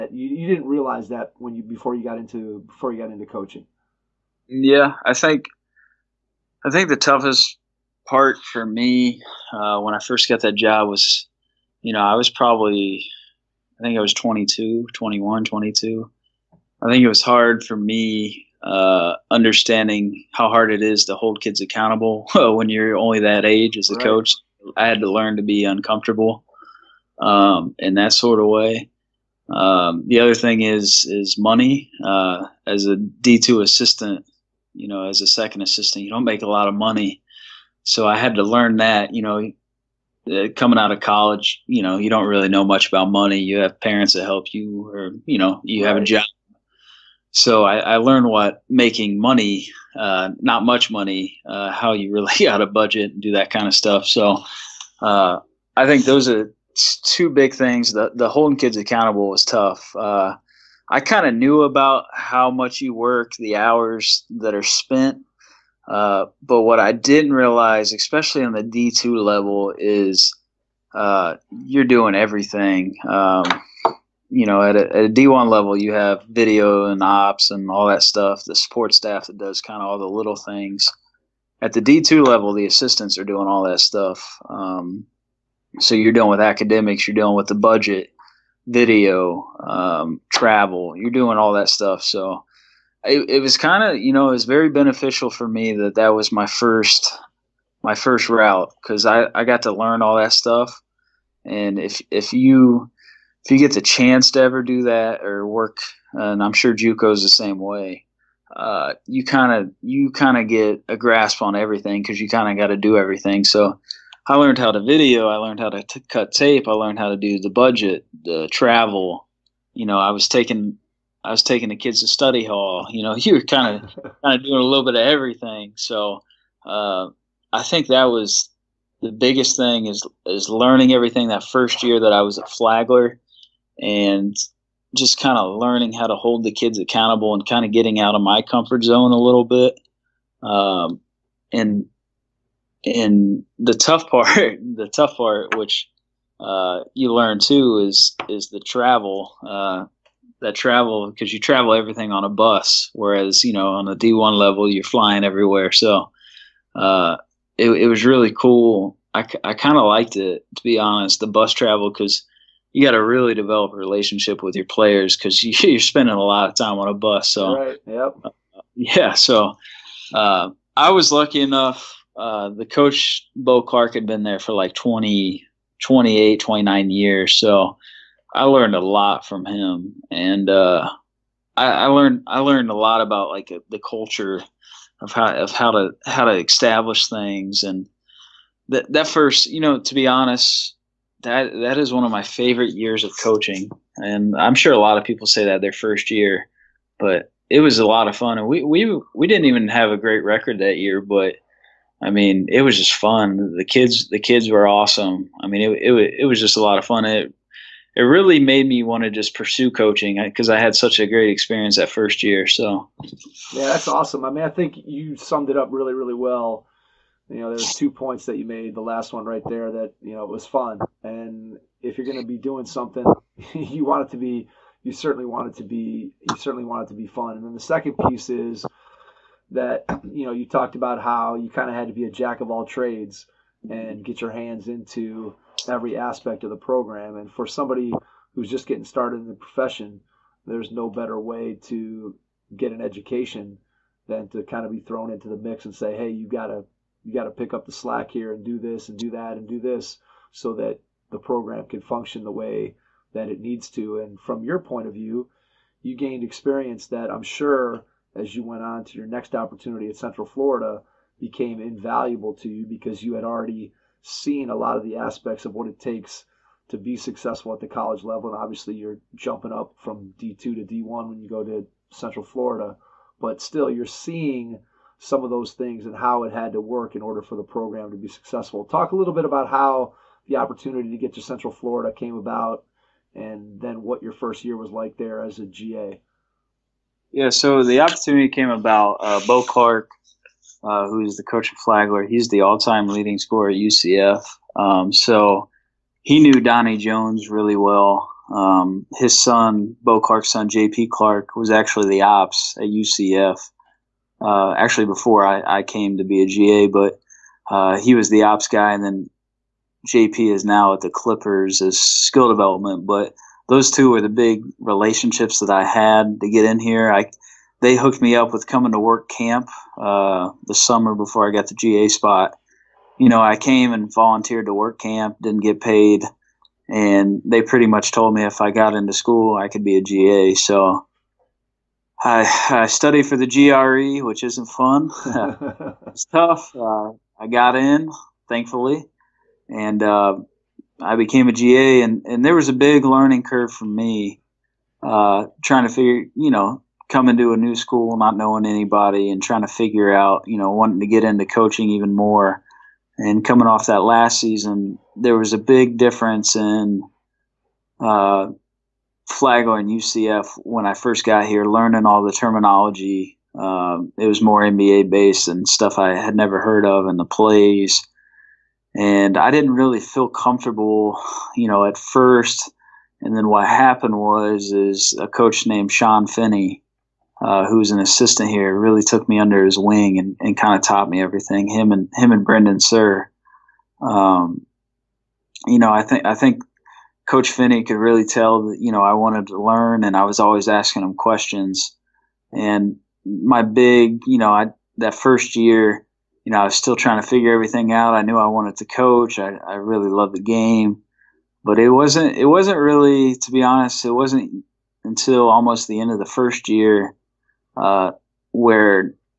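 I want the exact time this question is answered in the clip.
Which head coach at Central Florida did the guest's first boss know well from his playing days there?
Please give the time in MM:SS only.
04:56.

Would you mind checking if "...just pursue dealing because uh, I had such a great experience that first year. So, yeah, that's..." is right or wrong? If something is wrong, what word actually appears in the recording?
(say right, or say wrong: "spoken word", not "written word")
wrong: "coaching", not "dealing".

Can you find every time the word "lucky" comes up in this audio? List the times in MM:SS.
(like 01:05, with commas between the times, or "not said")
02:51.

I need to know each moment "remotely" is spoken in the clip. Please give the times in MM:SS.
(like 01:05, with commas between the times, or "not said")
not said.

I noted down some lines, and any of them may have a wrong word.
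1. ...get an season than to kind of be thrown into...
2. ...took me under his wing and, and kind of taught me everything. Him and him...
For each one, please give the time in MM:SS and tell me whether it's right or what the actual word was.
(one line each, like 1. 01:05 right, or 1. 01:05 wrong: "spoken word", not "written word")
1. 04:02 wrong: "education", not "season"
2. 06:18 right.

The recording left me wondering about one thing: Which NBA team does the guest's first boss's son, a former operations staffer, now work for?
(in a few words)
Clippers.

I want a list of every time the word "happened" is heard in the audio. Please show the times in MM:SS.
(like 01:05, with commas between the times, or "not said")
06:13.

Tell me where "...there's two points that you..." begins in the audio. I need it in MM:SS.
03:37.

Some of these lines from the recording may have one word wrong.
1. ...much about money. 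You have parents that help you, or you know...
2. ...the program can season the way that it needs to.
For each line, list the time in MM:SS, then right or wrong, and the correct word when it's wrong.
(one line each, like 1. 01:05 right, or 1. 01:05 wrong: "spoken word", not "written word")
1. 00:42 right
2. 04:11 wrong: "function", not "season".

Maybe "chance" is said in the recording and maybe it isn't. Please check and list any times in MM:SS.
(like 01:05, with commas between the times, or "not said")
01:43.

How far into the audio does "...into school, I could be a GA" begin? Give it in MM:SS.
05:28.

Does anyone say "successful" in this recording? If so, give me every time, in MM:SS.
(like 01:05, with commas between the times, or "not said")
04:26, 04:38.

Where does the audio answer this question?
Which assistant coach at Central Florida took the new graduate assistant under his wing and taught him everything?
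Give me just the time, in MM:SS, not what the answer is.
06:15.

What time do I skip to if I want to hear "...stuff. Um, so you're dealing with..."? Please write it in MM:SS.
01:23.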